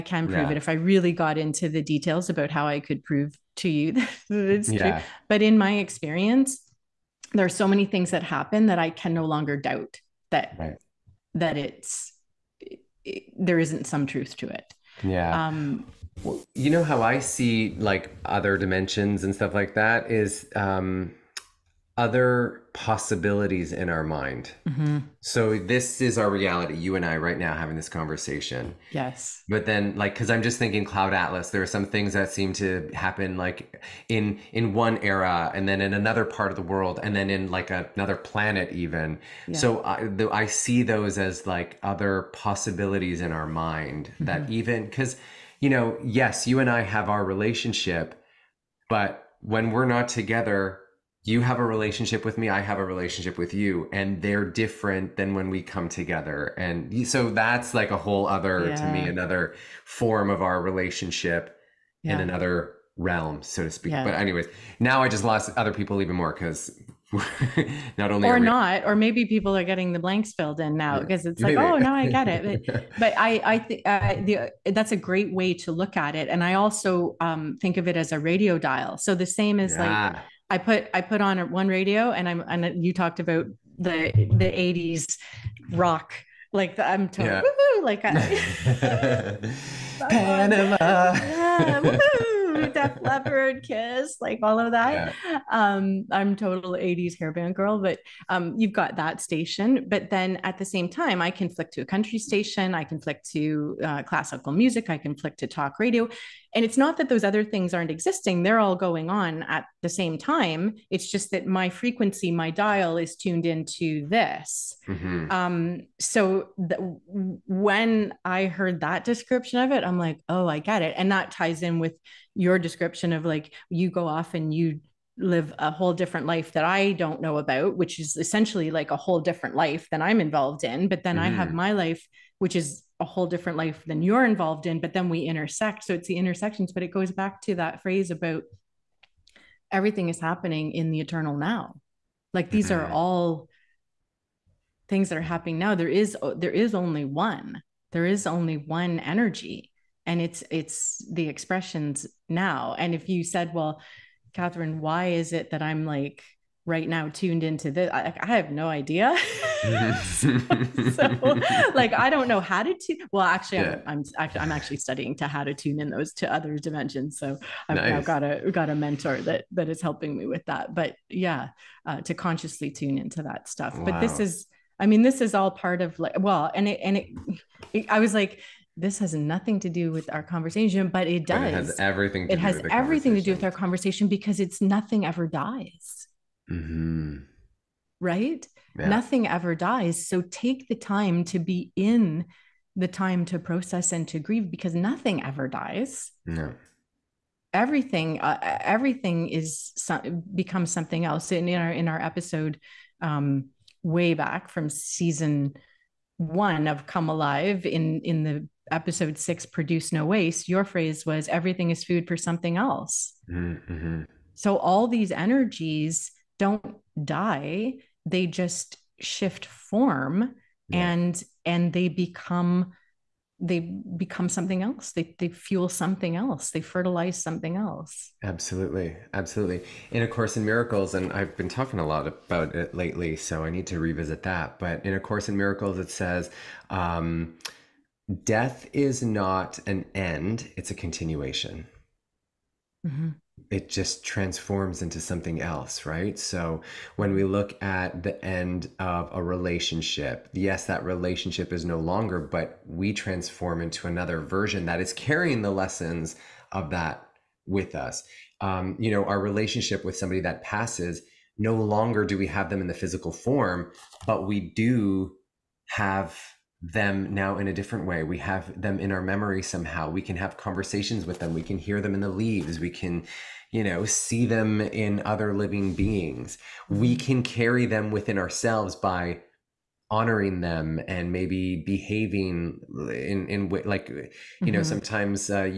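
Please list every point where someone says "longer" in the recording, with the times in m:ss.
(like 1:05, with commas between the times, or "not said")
0:09, 4:11, 4:21.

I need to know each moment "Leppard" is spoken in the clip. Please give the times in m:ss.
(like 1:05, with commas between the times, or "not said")
1:33.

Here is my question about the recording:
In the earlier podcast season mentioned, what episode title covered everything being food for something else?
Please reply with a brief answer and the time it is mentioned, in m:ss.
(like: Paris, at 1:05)
Produce No Waste, at 3:29.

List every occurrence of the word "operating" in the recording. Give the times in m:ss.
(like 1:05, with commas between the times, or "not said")
not said.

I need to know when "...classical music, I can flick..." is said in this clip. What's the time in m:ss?
1:44.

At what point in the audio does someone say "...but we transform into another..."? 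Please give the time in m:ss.
4:12.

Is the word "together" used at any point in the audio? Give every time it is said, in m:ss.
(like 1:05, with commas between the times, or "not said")
0:50, 0:55.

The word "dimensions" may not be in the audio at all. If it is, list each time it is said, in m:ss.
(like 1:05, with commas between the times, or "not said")
0:18, 2:46.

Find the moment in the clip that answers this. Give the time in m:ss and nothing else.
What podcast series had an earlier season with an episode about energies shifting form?
3:26.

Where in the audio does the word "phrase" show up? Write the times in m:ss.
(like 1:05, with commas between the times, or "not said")
2:17, 3:30.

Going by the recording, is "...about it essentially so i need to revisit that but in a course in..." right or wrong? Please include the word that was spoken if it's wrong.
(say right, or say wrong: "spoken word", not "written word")
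wrong: "lately", not "essentially".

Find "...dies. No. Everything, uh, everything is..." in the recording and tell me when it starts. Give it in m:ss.
3:15.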